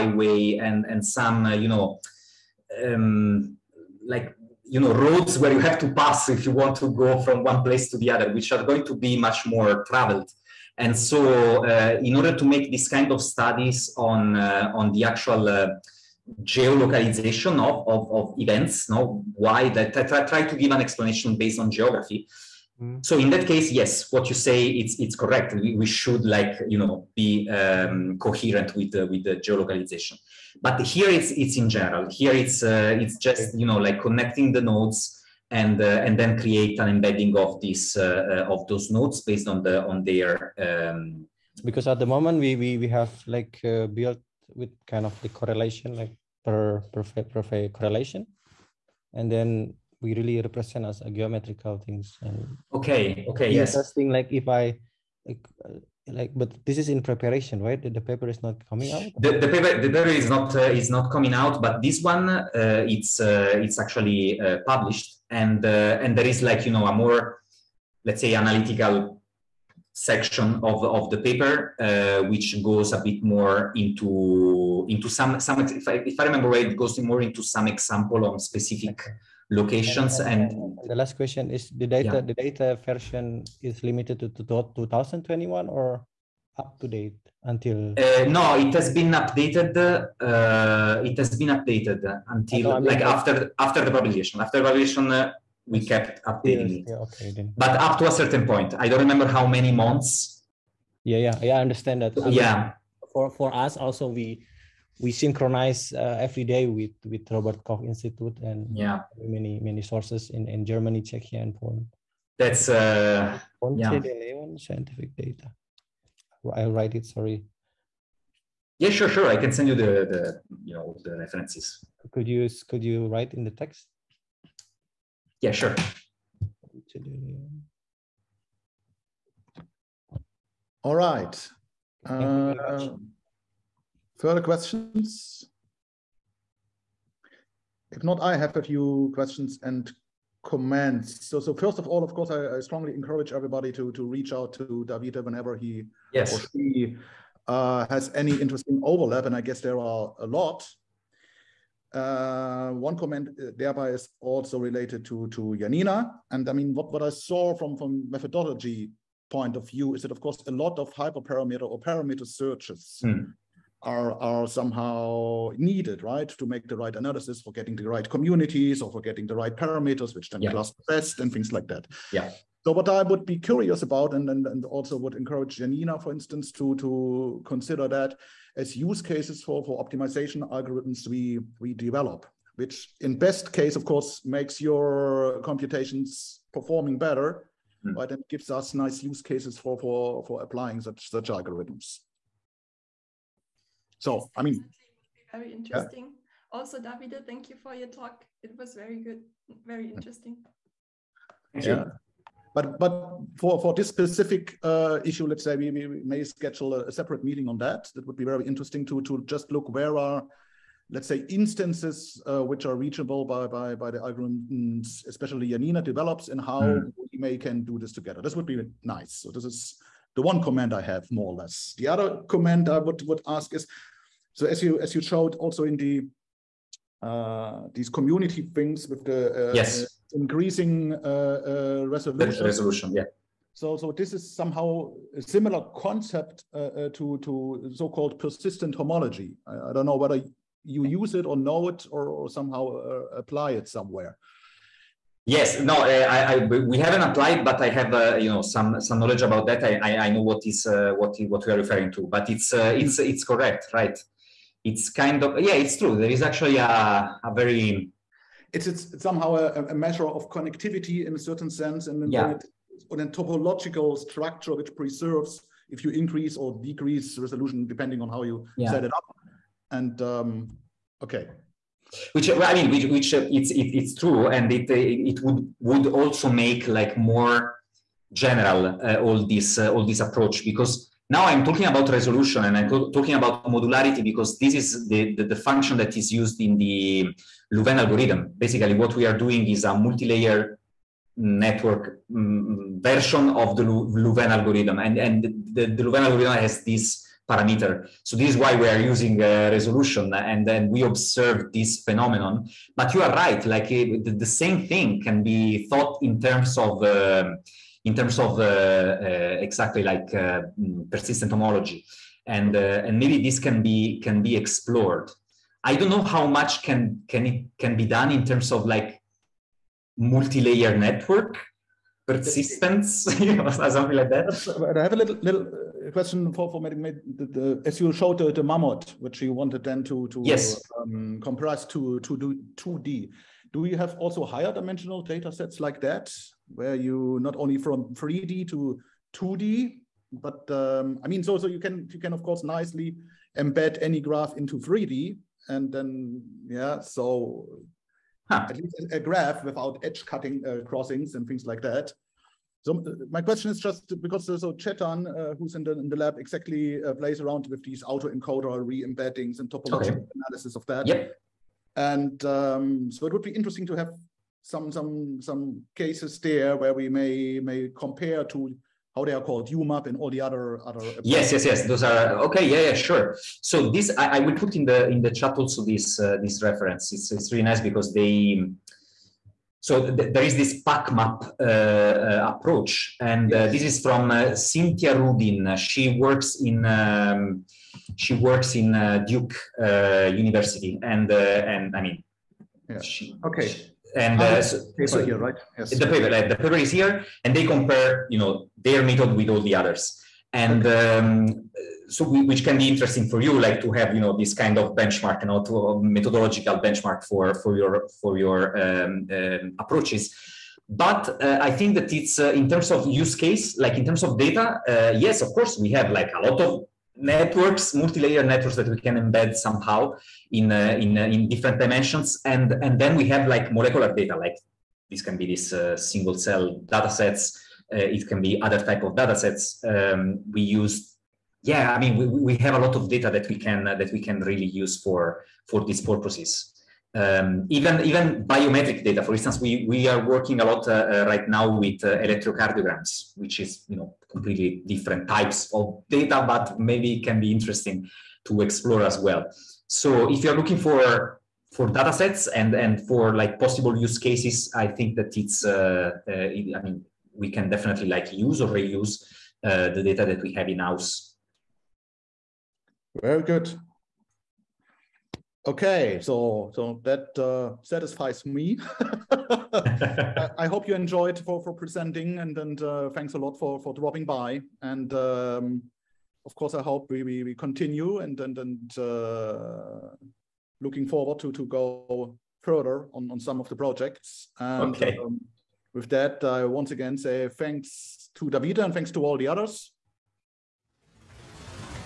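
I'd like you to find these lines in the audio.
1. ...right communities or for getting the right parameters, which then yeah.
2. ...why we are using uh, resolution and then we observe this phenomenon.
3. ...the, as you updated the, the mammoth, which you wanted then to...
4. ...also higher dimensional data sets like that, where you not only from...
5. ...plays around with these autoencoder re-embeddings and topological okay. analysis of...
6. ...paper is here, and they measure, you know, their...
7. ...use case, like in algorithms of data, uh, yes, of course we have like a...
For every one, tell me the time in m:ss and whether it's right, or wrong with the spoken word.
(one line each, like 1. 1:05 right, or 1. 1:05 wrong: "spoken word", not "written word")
1. 2:47 right
2. 4:58 right
3. 5:27 wrong: "showed", not "updated"
4. 5:33 right
5. 5:56 right
6. 6:36 wrong: "compare", not "measure"
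7. 6:52 wrong: "terms", not "algorithms".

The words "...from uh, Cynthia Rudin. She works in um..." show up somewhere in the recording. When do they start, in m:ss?
6:23.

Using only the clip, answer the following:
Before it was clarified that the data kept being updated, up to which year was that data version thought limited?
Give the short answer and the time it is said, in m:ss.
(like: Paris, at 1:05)
2021, at 1:24.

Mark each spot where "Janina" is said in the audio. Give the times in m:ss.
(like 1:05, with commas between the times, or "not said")
2:35, 2:55.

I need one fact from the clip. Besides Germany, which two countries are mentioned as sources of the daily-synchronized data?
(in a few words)
Czechia and Poland.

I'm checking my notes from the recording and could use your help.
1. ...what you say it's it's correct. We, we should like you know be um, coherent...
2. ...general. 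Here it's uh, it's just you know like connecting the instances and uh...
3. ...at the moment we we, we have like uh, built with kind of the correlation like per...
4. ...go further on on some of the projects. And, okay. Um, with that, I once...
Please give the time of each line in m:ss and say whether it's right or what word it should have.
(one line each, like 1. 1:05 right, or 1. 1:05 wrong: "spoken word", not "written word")
1. 0:24 right
2. 0:31 wrong: "nodes", not "instances"
3. 0:41 right
4. 8:01 right.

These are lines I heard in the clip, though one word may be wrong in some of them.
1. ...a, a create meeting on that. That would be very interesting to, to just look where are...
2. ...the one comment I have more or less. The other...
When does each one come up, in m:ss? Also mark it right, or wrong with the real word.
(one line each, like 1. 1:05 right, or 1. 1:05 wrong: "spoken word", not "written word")
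1. 3:26 wrong: "separate", not "create"
2. 3:40 right.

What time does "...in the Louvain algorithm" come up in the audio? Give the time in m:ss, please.
4:46.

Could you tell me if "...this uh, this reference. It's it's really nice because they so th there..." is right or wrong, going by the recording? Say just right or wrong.
right.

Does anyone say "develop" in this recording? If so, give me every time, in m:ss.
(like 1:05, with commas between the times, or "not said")
3:01, 3:35.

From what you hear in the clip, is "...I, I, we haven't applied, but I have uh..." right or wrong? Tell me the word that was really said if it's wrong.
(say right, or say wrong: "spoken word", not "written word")
right.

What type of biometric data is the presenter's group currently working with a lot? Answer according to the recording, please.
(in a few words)
Electrocardiograms.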